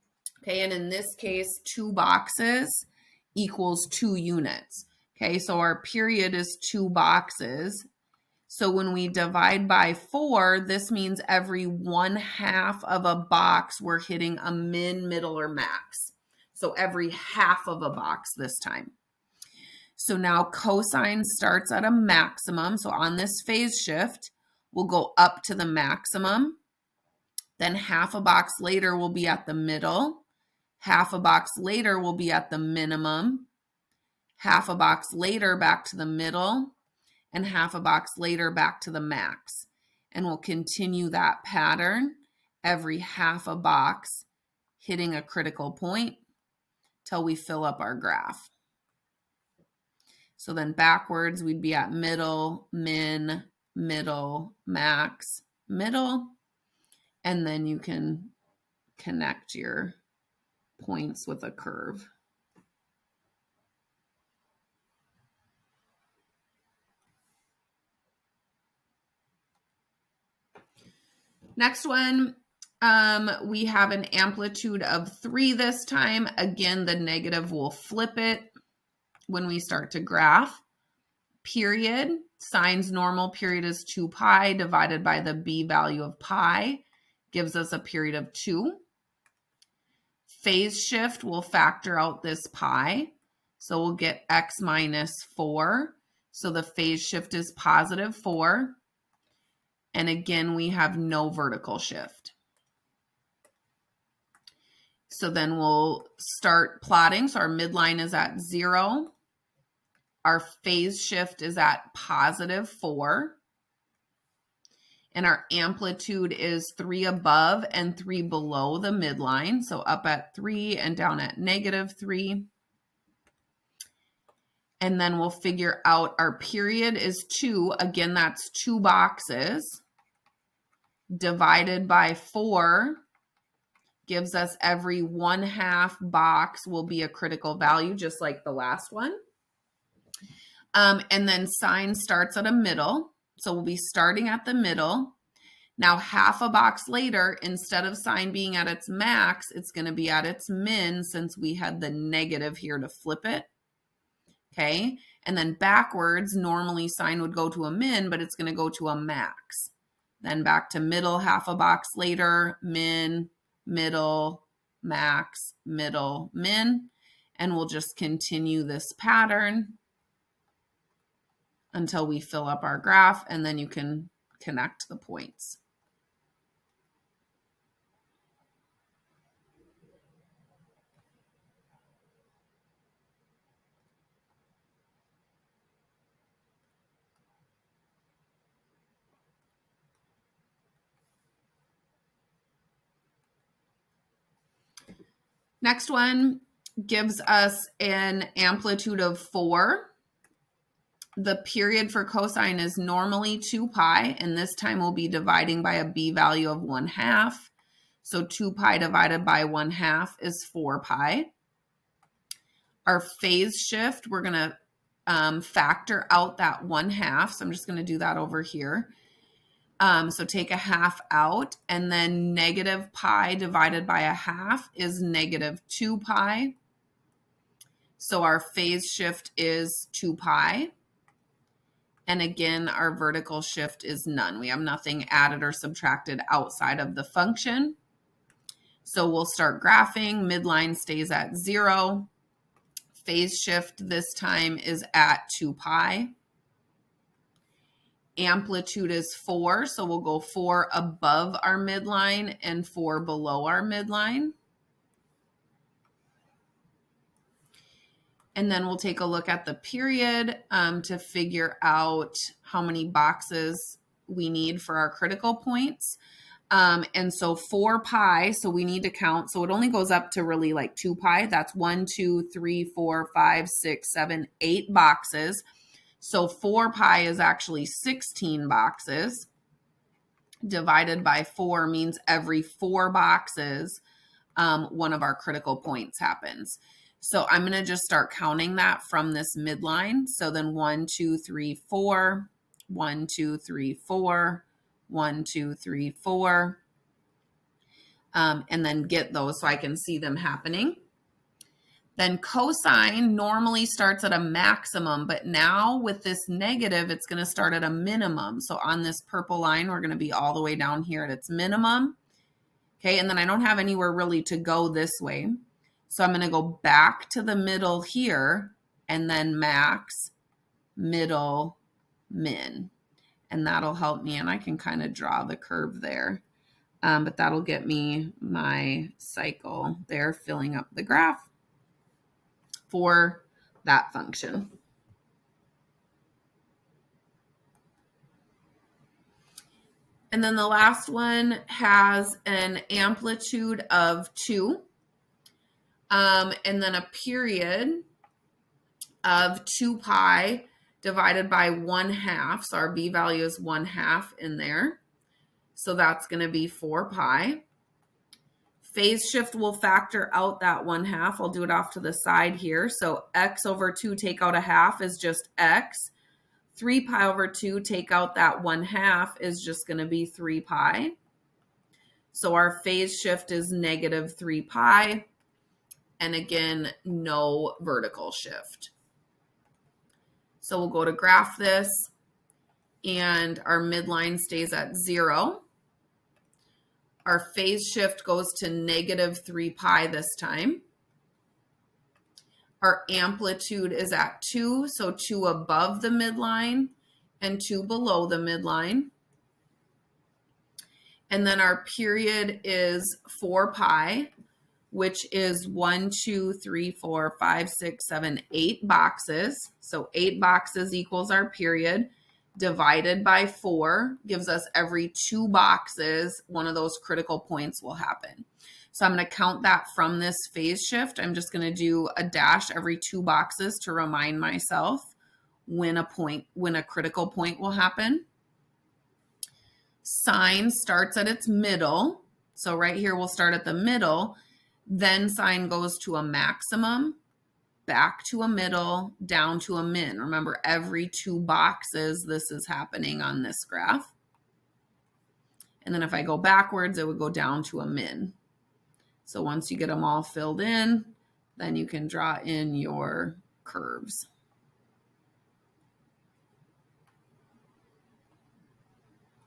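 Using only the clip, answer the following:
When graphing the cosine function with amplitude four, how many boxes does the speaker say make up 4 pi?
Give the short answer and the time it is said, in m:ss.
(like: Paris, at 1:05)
16, at 4:37.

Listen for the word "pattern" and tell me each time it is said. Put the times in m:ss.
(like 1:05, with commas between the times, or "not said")
0:41, 2:48.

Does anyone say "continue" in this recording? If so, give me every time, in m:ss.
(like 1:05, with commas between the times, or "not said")
0:40, 2:47.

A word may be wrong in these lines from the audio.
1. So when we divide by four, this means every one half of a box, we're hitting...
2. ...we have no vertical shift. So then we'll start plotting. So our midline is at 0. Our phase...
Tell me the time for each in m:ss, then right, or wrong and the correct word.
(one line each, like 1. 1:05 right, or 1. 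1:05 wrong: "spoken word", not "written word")
1. 0:08 right
2. 1:40 right.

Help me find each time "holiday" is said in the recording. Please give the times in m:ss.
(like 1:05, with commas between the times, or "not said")
not said.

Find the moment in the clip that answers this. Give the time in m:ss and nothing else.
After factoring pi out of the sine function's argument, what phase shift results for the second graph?
1:36.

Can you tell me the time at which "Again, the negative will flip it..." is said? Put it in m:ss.
1:16.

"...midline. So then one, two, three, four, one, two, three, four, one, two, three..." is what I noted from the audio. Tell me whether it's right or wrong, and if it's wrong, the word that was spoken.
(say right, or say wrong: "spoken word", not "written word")
right.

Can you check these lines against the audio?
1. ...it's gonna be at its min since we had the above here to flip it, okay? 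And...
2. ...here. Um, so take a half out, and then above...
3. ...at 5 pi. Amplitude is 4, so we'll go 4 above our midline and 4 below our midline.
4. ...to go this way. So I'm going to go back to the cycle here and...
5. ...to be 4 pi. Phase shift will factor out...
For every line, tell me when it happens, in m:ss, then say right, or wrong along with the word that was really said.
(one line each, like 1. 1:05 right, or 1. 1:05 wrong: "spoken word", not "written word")
1. 2:29 wrong: "negative", not "above"
2. 3:38 wrong: "negative", not "above"
3. 4:04 wrong: "2", not "5"
4. 5:14 wrong: "middle", not "cycle"
5. 5:56 right.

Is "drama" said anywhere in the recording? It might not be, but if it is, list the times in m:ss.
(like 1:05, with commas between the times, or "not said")
not said.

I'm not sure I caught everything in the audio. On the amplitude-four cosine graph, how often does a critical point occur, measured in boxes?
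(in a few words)
every 4 boxes.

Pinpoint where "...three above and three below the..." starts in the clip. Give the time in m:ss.
1:56.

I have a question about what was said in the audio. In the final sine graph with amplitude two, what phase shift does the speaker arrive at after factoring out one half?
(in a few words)
negative 3 pi.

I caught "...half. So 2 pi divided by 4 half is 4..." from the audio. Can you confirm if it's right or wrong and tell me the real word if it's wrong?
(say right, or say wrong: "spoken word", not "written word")
wrong: "1", not "4".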